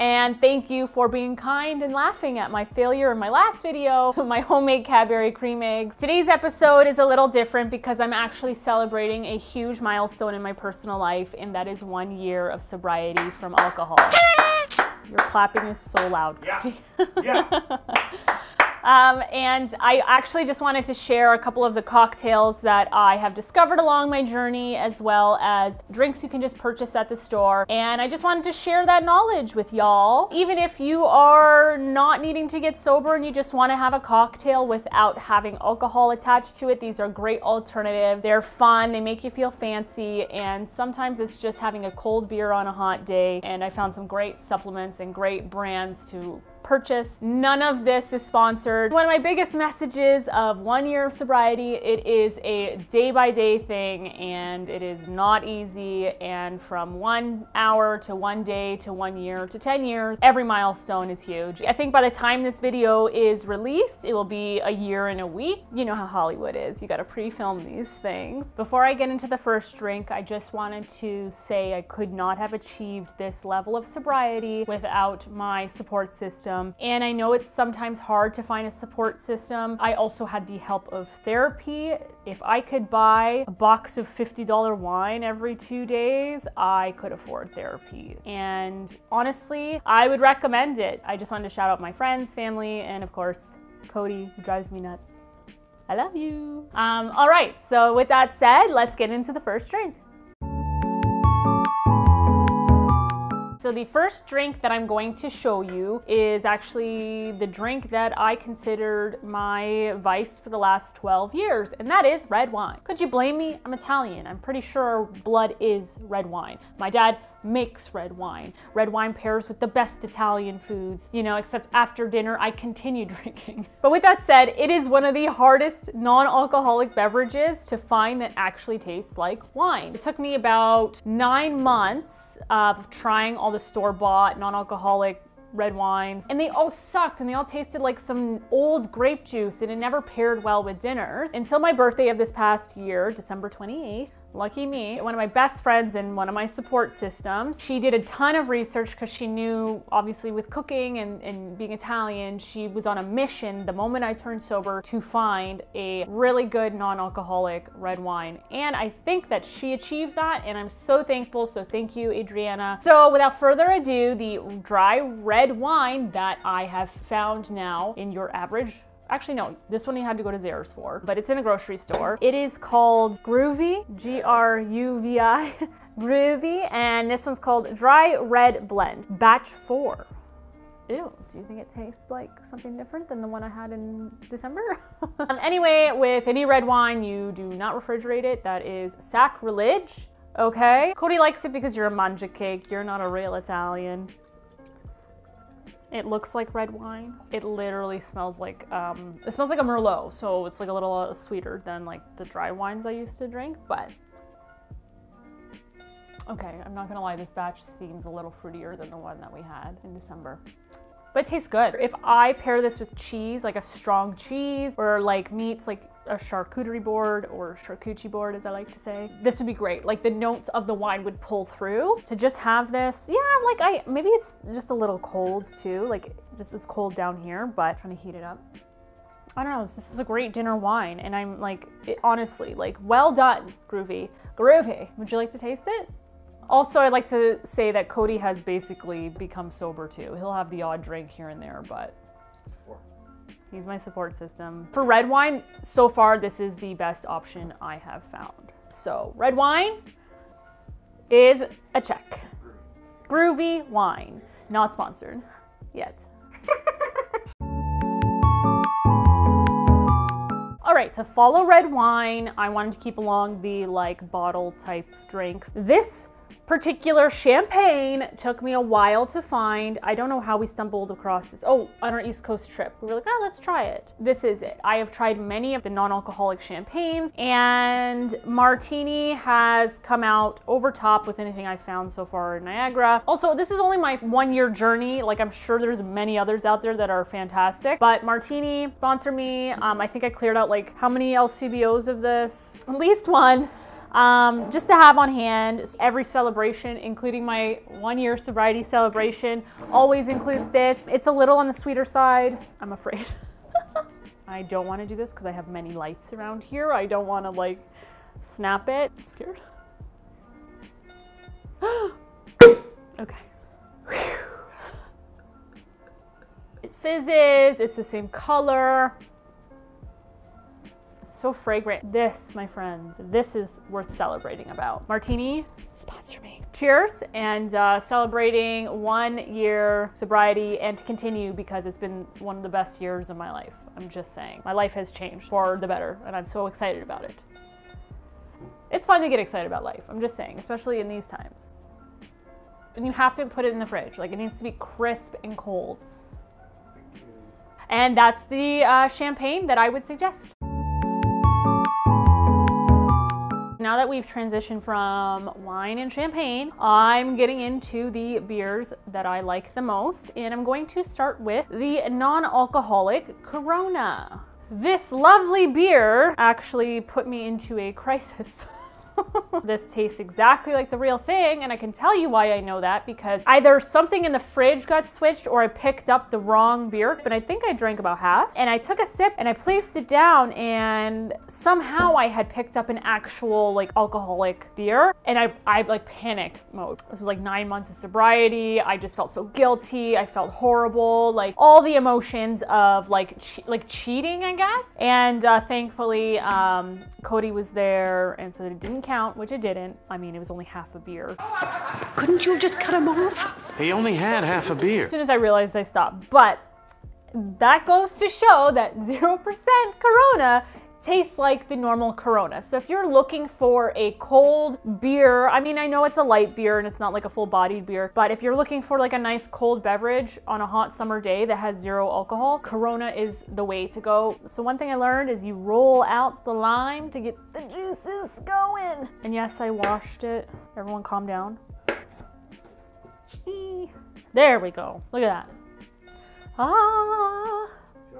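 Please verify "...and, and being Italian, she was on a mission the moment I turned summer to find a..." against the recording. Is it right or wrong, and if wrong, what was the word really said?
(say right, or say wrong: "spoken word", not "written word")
wrong: "sober", not "summer".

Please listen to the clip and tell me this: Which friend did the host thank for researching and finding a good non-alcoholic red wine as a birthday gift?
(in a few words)
Adriana.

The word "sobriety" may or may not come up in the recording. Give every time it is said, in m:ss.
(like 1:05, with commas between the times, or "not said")
0:12, 0:51, 1:13, 4:58, 5:29, 6:27.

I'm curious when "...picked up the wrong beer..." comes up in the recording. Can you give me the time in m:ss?
6:15.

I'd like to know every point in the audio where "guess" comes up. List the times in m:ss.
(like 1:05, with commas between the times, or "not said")
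6:34.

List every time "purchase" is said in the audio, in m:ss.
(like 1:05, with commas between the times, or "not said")
0:26, 0:46.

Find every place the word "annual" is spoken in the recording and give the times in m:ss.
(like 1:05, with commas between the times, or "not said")
not said.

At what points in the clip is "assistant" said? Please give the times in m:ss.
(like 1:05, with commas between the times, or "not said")
not said.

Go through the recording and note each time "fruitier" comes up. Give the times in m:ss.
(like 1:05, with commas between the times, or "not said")
3:28.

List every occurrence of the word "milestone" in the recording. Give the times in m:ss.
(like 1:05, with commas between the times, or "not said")
0:09, 1:00.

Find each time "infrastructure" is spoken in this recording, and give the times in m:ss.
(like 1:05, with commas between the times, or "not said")
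not said.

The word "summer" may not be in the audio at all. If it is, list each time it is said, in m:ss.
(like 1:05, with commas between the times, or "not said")
7:00.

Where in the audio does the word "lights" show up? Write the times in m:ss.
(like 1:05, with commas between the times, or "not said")
5:05, 6:56.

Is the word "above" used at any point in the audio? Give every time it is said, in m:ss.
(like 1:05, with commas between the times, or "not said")
not said.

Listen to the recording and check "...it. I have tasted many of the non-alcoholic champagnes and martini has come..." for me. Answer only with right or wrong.
wrong.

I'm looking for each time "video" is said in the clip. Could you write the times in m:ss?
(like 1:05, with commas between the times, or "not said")
0:03, 1:02.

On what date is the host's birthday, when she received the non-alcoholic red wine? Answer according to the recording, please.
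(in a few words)
December 28th.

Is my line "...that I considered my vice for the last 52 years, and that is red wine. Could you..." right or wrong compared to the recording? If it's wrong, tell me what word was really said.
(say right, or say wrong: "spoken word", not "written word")
wrong: "12", not "52".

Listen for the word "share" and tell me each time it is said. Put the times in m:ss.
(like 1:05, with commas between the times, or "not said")
0:20, 0:28.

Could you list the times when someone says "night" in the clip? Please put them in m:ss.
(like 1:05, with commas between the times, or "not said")
not said.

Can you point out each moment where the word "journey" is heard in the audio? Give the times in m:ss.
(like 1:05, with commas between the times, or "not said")
0:24, 4:44.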